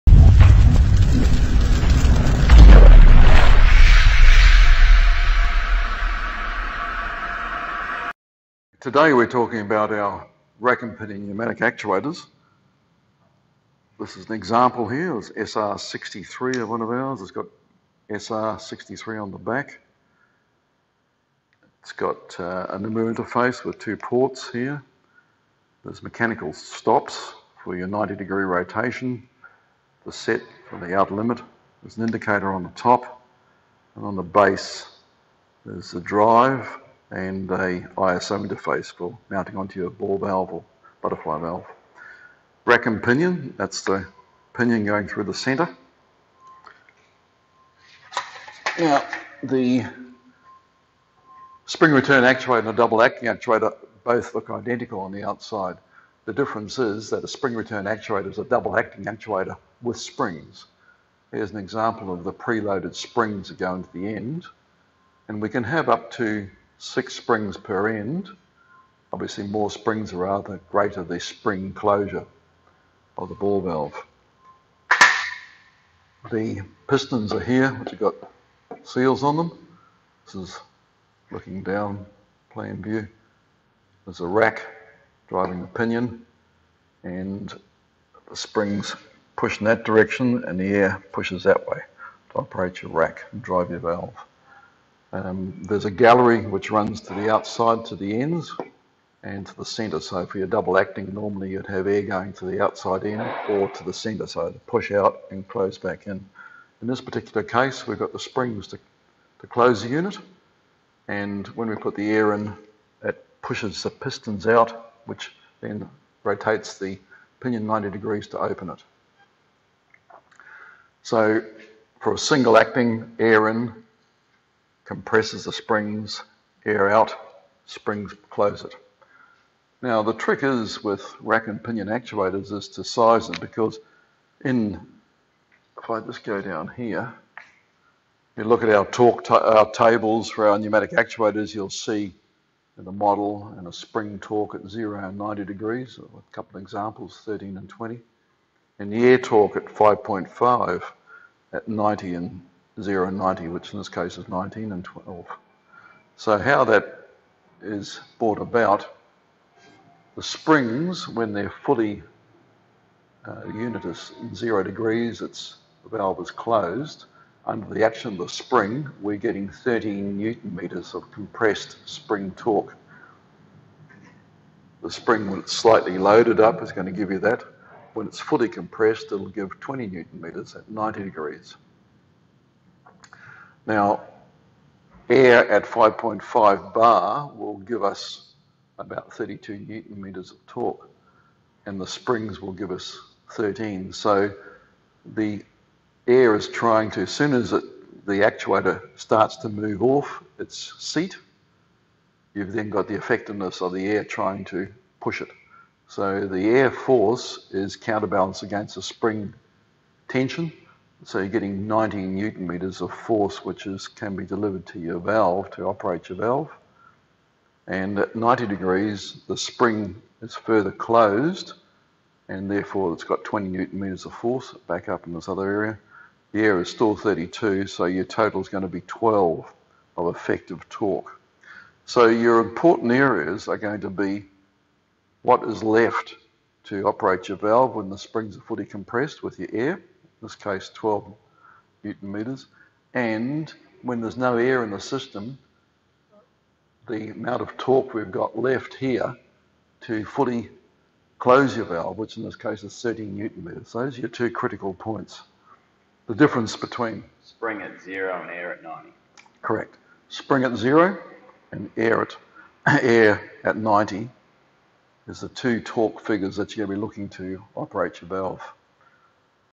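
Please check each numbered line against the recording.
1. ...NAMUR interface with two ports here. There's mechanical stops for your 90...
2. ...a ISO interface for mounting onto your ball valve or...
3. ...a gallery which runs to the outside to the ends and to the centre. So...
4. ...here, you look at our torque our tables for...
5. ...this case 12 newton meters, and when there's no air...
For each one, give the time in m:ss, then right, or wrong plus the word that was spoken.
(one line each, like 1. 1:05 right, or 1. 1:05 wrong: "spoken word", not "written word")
1. 0:22 right
2. 0:37 right
3. 1:35 right
4. 2:16 right
5. 4:00 right.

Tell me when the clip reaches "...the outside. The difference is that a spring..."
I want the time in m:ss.
0:55.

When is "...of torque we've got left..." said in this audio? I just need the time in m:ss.
4:07.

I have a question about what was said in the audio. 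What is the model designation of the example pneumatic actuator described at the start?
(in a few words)
SR63.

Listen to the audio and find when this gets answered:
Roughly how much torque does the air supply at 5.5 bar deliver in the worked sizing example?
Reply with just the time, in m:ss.
3:09.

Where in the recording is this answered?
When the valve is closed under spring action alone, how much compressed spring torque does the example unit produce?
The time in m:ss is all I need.
2:49.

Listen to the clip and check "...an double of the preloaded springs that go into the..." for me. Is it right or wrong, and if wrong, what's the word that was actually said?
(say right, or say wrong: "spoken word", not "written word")
wrong: "example", not "double".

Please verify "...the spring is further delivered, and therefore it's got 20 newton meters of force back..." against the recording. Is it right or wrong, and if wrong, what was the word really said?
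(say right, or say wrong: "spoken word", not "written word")
wrong: "closed", not "delivered".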